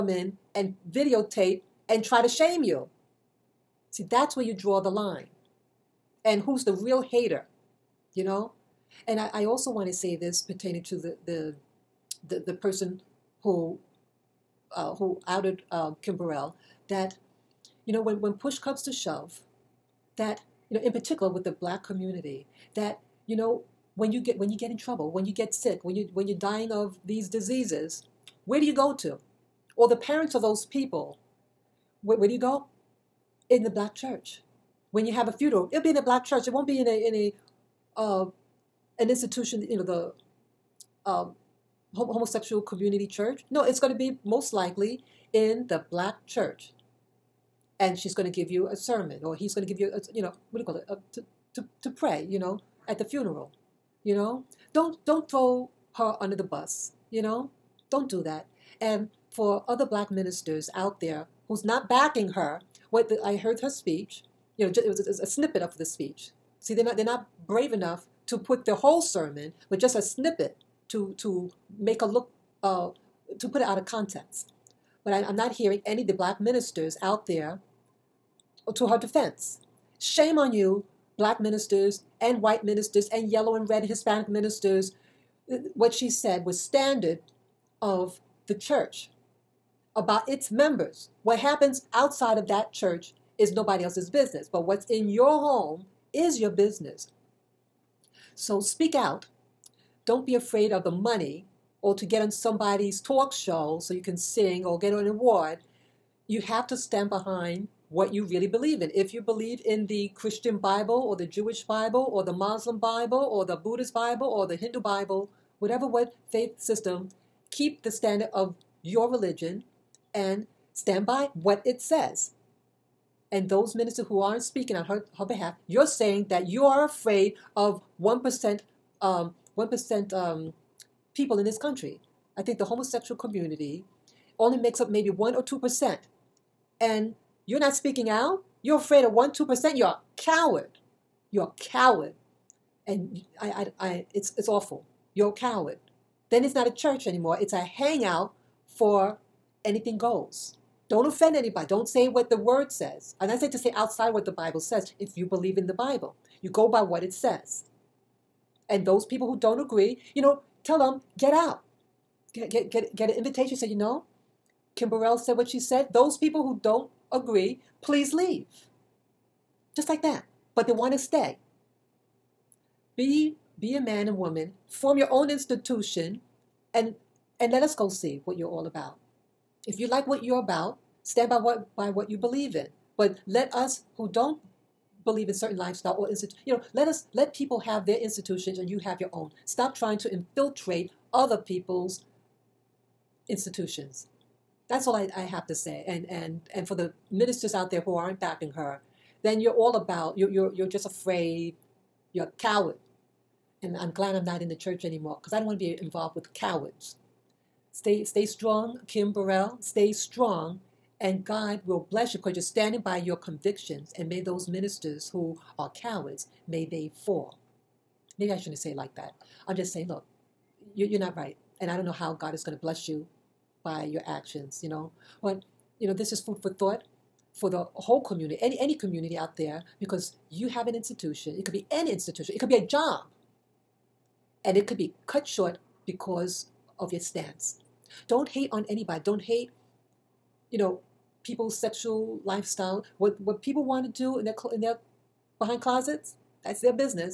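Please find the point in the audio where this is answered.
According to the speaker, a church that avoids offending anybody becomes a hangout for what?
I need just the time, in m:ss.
2:29.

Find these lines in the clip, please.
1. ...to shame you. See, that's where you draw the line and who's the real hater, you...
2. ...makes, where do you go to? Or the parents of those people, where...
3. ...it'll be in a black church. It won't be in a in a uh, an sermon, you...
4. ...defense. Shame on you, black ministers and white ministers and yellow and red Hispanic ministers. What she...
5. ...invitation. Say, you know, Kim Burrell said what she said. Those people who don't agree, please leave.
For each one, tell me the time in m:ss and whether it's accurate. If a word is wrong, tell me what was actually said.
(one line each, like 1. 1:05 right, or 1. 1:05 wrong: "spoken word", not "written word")
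1. 0:02 right
2. 0:27 wrong: "diseases", not "makes"
3. 0:35 wrong: "institution", not "sermon"
4. 1:18 right
5. 2:43 right.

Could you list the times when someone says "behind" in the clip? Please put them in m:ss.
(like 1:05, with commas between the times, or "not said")
1:47, 4:05.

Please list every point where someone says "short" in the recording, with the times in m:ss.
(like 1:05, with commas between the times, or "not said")
3:55.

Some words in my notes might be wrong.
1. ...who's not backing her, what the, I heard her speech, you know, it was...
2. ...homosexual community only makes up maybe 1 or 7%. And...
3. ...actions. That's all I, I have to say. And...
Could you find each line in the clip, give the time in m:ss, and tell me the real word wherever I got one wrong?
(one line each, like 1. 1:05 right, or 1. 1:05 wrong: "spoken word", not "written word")
1. 1:01 right
2. 2:12 wrong: "2", not "7"
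3. 3:13 wrong: "institutions", not "actions".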